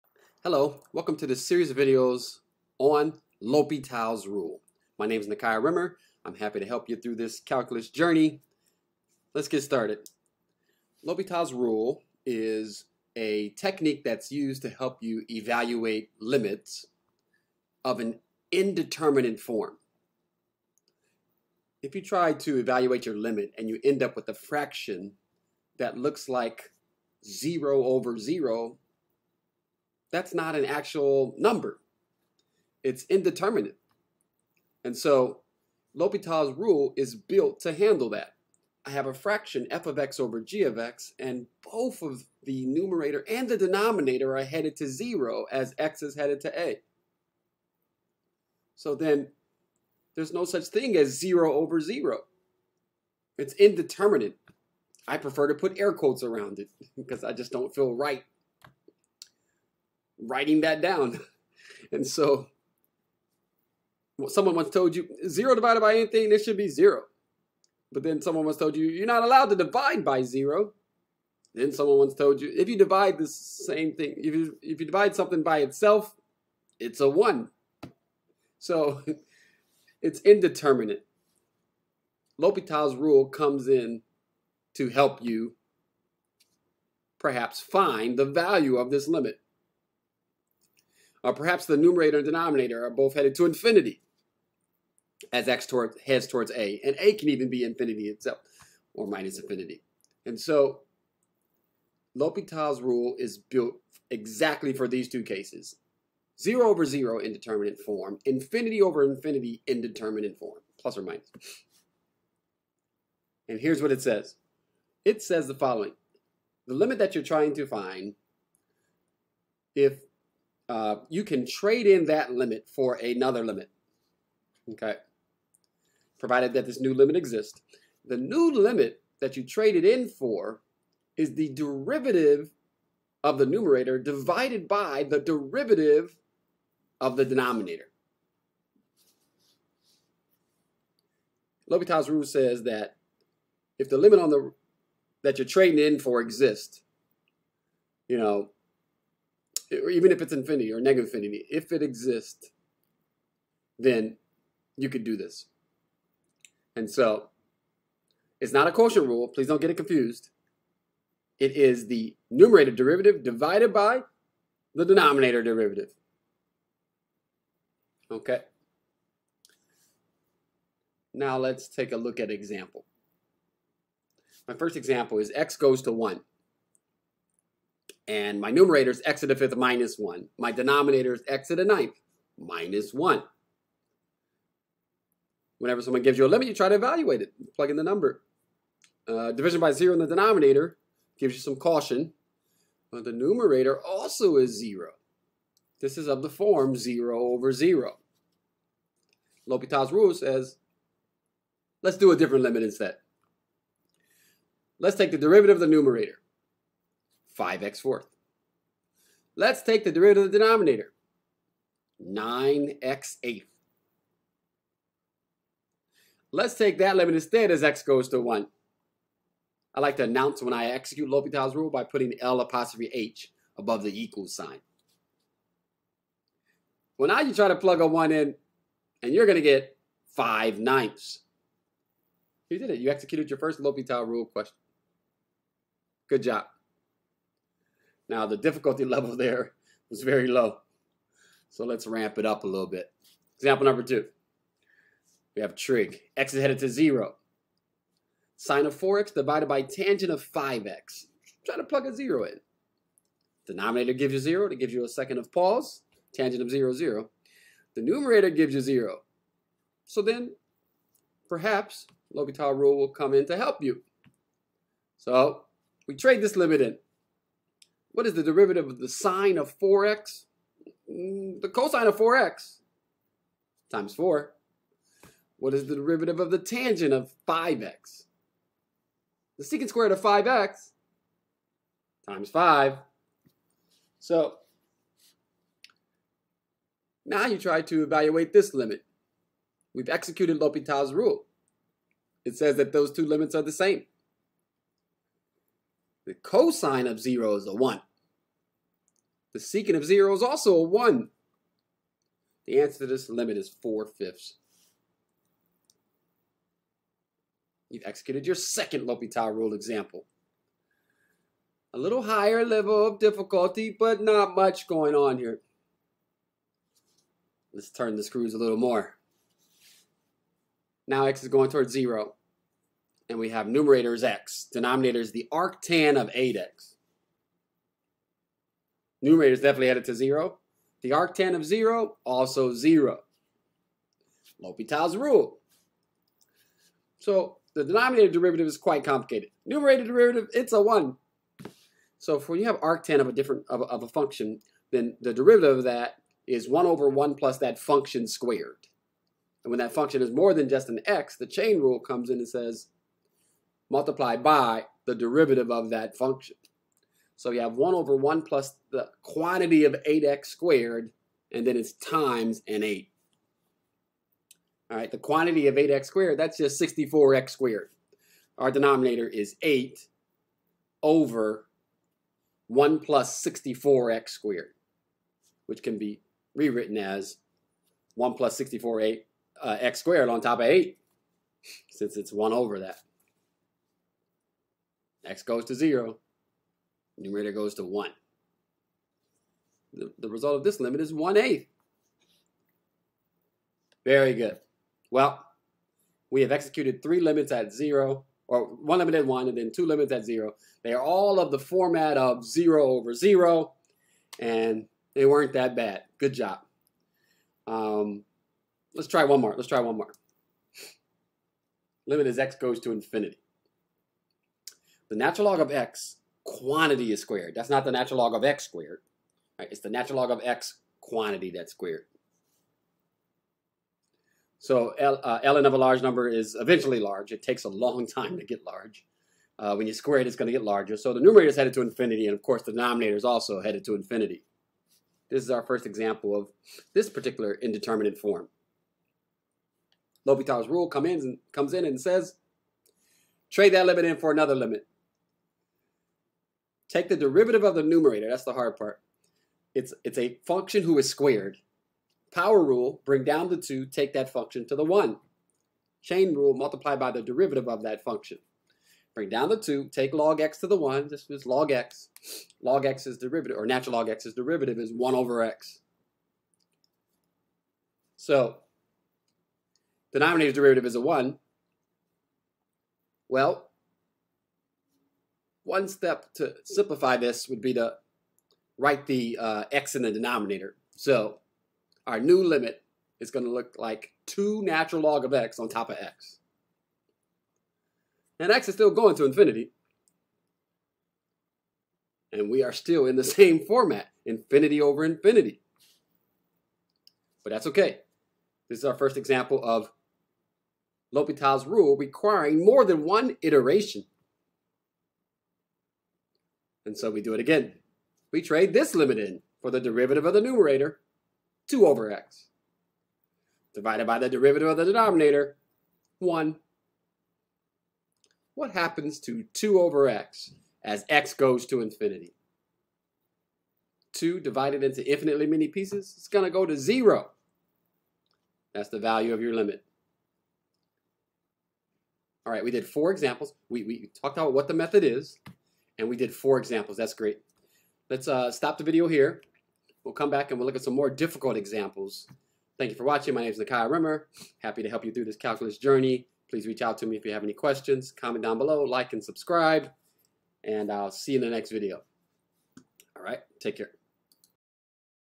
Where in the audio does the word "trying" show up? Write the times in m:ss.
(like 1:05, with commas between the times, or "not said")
1:57.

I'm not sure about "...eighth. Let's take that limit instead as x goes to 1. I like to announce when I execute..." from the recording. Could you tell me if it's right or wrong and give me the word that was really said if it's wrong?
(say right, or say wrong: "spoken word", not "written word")
right.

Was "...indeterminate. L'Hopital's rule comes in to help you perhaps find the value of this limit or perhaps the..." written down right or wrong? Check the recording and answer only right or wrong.
right.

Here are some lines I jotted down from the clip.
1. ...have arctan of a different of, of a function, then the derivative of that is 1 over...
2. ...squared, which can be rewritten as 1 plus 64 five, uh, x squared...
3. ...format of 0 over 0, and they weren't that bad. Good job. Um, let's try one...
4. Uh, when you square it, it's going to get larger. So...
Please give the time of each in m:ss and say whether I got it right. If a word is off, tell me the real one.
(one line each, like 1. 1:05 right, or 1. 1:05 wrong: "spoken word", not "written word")
1. 5:42 right
2. 6:14 wrong: "eight", not "five"
3. 6:41 right
4. 7:09 right.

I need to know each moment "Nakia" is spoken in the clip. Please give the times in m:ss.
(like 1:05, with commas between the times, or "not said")
0:05, 9:03.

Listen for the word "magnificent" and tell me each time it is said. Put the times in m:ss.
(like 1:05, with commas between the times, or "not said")
not said.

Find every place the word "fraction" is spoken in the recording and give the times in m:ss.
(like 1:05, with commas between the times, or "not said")
0:24, 0:39.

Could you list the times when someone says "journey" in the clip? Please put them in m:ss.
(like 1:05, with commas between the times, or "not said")
0:07, 9:05.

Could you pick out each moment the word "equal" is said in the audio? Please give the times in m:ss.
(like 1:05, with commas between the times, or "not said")
3:44.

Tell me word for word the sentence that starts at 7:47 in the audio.
So, denominator derivative is a 1.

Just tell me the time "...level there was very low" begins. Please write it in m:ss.
3:58.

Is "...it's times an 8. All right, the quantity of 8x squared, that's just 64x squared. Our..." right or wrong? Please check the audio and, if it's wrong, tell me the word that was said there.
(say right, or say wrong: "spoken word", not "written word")
right.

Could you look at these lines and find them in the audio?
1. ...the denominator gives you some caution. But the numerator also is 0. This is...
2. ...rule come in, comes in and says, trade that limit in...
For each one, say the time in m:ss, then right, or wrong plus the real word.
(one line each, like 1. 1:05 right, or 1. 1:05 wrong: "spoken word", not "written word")
1. 3:09 right
2. 7:20 right.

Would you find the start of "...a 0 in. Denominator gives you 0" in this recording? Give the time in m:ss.
4:11.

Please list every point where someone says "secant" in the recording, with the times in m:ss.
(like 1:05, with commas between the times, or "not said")
4:39, 4:59.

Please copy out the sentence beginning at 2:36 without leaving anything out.
And so it's not a quotient rule.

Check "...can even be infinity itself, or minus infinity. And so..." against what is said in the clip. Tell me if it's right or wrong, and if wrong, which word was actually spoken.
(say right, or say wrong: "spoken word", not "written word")
right.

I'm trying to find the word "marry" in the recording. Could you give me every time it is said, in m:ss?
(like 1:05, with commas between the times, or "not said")
not said.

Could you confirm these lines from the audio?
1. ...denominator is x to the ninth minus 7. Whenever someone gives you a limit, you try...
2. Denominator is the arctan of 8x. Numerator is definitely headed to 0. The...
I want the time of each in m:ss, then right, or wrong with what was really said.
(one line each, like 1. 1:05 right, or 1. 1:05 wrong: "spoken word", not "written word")
1. 3:00 wrong: "1", not "7"
2. 5:24 right.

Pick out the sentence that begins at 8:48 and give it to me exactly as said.
That's the value of your limit.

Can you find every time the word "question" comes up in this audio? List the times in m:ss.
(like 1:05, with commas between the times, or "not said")
3:54, 9:07.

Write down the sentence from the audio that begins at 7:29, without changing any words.
It's, it's a function who is squared.